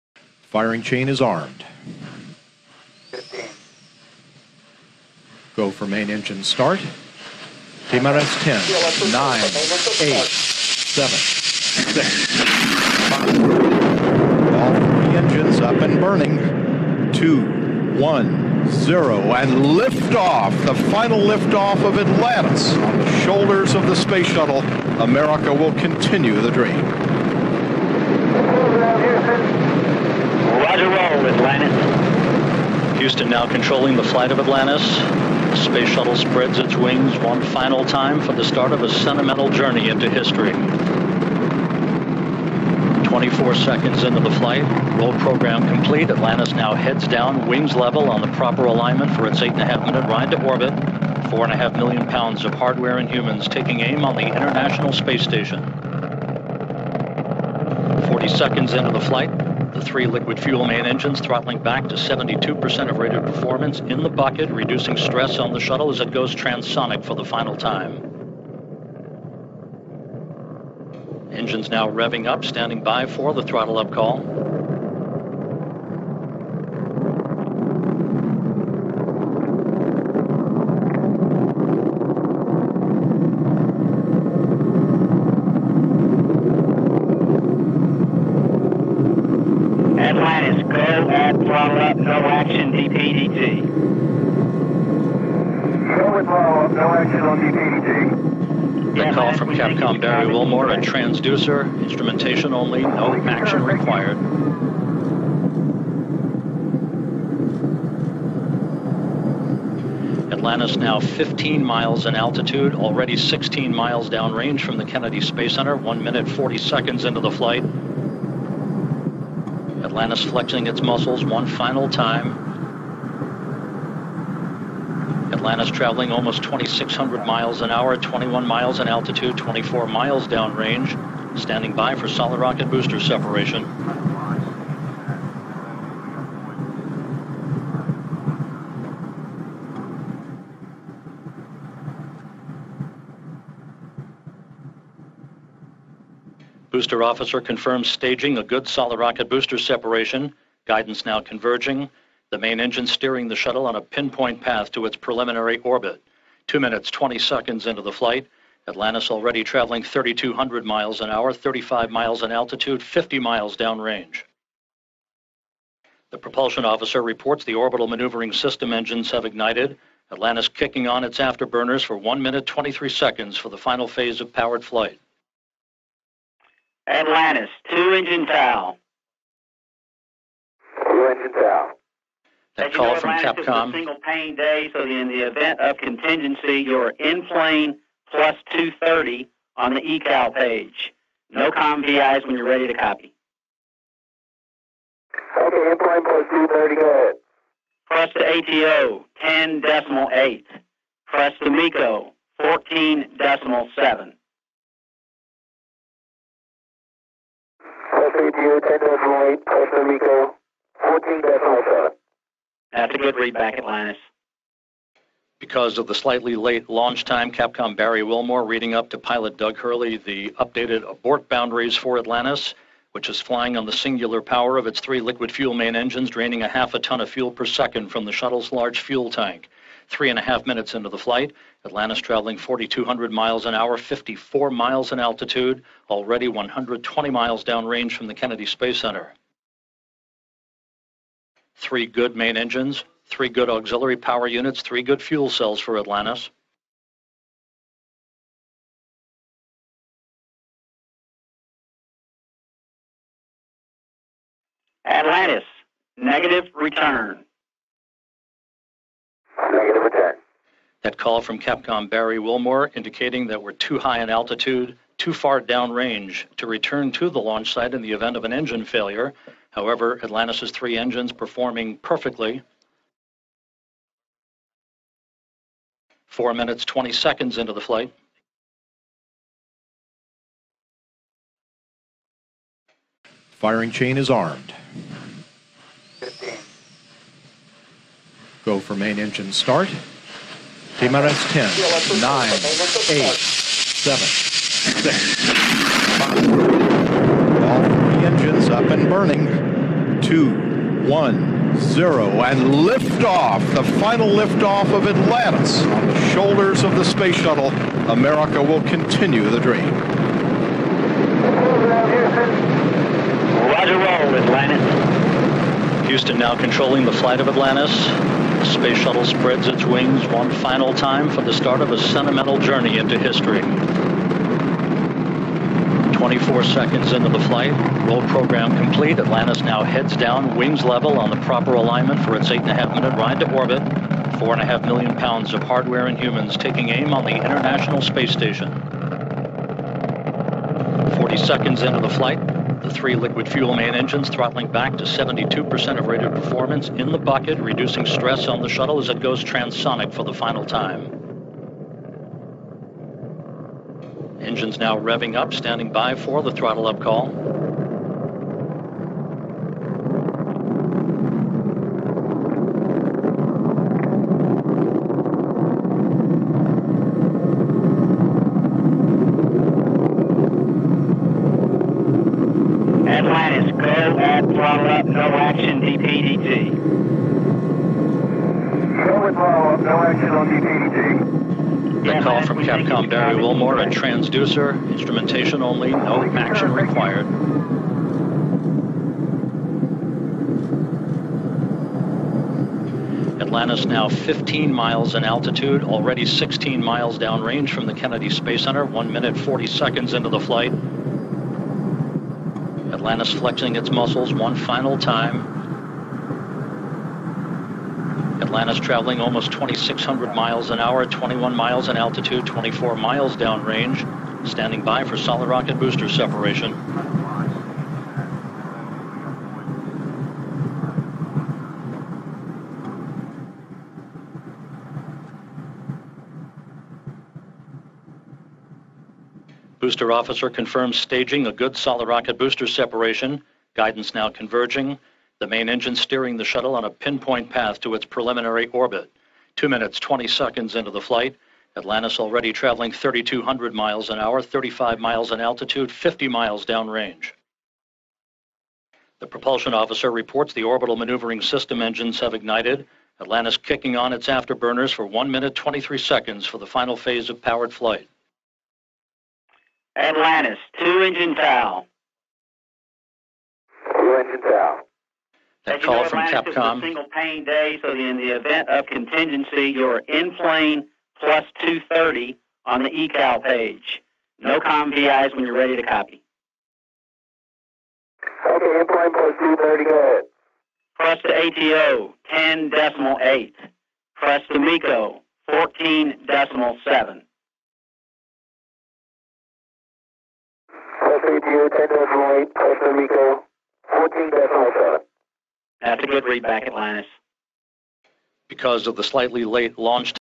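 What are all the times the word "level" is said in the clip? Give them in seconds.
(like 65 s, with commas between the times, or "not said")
47 s, 330 s.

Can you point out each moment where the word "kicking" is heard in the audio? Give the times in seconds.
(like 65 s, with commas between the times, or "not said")
170 s, 453 s.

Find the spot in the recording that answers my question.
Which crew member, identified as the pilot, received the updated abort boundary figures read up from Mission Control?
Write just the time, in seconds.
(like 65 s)
219 s.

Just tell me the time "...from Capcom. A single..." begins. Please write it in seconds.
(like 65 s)
465 s.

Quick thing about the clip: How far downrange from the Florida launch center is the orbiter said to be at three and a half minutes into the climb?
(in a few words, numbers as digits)
120 miles.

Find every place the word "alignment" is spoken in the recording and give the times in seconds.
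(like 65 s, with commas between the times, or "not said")
48 s, 331 s.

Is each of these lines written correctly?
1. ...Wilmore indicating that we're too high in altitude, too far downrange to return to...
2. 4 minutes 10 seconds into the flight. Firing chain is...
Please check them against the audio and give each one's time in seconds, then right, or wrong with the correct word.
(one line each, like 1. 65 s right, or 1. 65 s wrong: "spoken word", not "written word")
1. 262 s right
2. 276 s wrong: "20", not "10".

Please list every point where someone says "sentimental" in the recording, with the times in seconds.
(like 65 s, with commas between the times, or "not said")
38 s, 321 s.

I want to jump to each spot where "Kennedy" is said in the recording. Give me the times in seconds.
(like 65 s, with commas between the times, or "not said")
114 s, 238 s, 397 s.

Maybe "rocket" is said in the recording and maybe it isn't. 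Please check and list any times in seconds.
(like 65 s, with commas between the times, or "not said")
132 s, 148 s, 415 s, 431 s.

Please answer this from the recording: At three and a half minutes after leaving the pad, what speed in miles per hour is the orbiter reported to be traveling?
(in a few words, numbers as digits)
4,200 miles an hour.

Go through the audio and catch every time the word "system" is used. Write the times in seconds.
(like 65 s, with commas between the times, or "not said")
168 s, 451 s.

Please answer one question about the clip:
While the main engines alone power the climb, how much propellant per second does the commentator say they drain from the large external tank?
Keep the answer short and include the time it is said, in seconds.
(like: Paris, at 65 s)
Half a ton, at 226 s.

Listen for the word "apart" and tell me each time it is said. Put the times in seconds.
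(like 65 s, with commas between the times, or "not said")
not said.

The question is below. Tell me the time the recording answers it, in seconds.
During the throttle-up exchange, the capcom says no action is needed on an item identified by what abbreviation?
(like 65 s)
380 s.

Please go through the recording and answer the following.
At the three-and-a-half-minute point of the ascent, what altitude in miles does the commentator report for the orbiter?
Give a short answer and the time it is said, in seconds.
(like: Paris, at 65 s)
54 miles, at 233 s.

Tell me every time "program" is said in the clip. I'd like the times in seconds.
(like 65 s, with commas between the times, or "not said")
45 s, 328 s.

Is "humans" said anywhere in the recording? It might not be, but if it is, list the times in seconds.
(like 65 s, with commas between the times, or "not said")
53 s, 335 s.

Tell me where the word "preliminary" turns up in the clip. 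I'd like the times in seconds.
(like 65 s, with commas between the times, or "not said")
154 s, 437 s.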